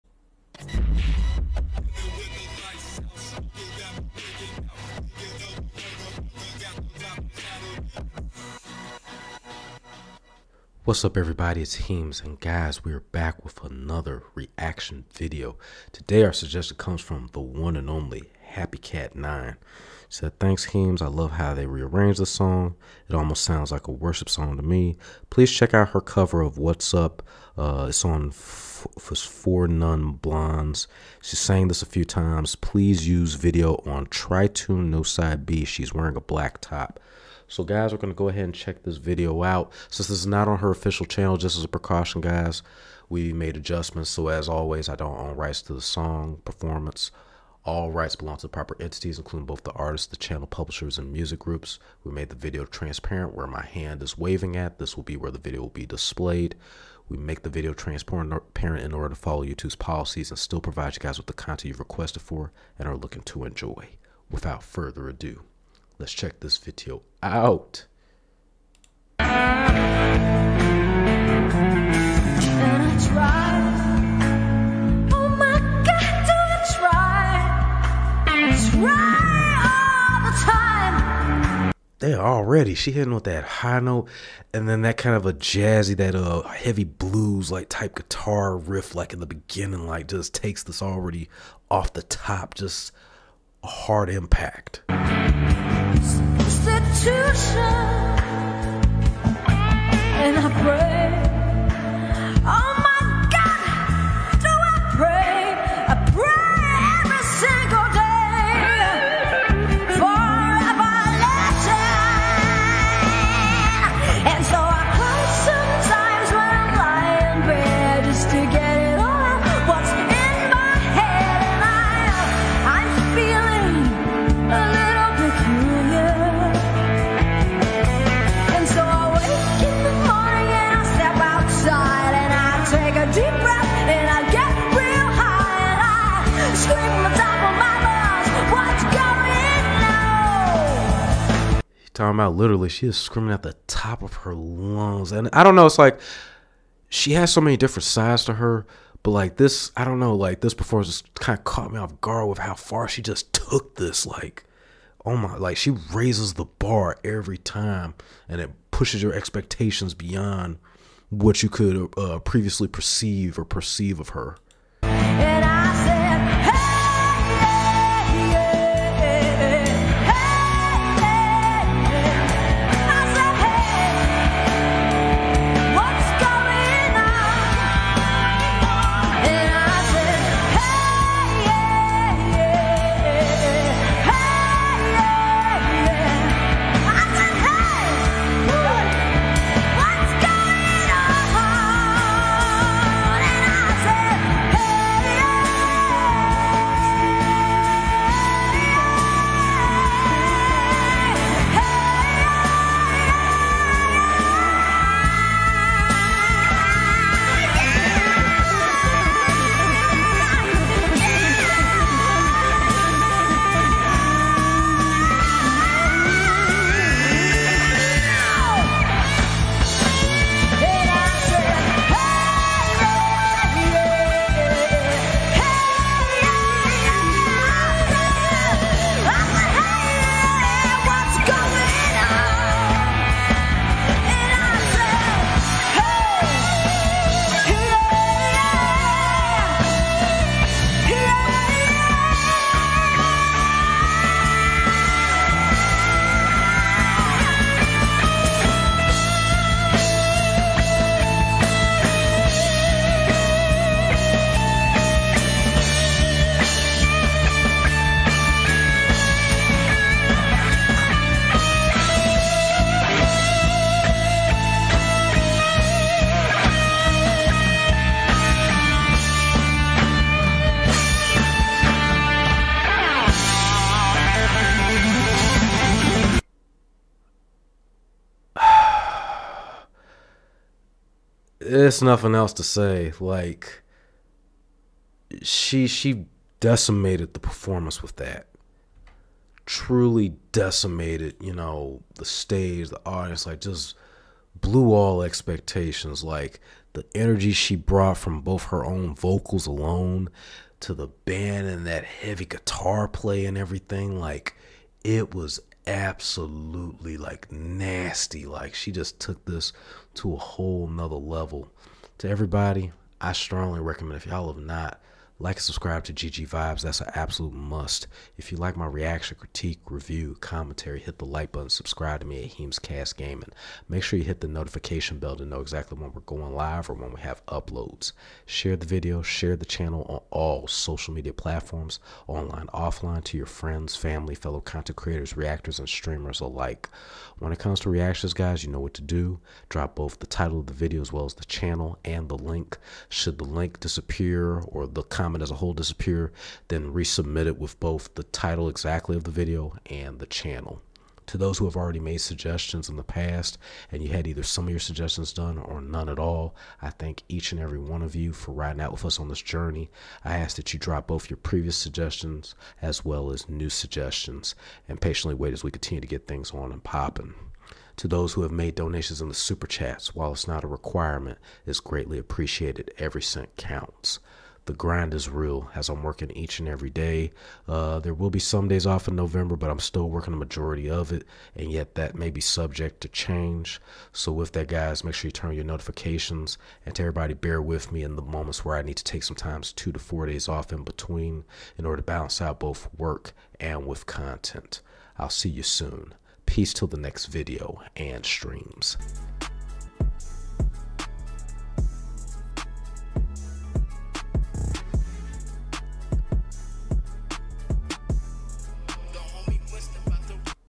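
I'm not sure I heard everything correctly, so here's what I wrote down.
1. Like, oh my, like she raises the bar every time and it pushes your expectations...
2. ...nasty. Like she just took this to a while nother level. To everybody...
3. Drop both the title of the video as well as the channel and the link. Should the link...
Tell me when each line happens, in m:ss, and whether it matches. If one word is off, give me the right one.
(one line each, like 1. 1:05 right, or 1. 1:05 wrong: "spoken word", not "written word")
1. 2:34 right
2. 5:07 wrong: "whole", not "while"
3. 5:39 right.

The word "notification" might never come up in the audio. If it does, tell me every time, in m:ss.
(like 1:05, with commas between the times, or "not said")
5:24, 6:25.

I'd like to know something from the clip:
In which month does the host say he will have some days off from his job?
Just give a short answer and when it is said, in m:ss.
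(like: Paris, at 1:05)
November, at 6:18.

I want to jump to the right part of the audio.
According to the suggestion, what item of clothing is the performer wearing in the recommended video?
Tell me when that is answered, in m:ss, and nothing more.
0:36.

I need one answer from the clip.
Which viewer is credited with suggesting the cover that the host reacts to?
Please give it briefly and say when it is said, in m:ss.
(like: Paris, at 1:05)
Happy Cat 9, at 0:18.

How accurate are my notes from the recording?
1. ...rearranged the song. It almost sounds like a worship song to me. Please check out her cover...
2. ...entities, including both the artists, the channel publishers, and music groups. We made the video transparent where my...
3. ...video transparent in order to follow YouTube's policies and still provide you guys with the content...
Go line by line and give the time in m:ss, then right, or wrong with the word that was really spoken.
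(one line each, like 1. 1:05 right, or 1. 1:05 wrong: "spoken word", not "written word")
1. 0:21 right
2. 0:48 right
3. 0:57 right.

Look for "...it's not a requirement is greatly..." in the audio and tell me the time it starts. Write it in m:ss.
6:10.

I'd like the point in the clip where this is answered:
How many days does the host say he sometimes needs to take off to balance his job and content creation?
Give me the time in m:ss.
6:29.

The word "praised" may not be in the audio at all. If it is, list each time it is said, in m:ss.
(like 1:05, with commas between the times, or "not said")
not said.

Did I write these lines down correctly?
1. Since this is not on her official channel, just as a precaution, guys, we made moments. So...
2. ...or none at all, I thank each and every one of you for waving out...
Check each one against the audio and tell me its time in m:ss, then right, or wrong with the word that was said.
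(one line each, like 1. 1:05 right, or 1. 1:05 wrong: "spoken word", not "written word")
1. 0:39 wrong: "adjustments", not "moments"
2. 5:55 wrong: "riding", not "waving".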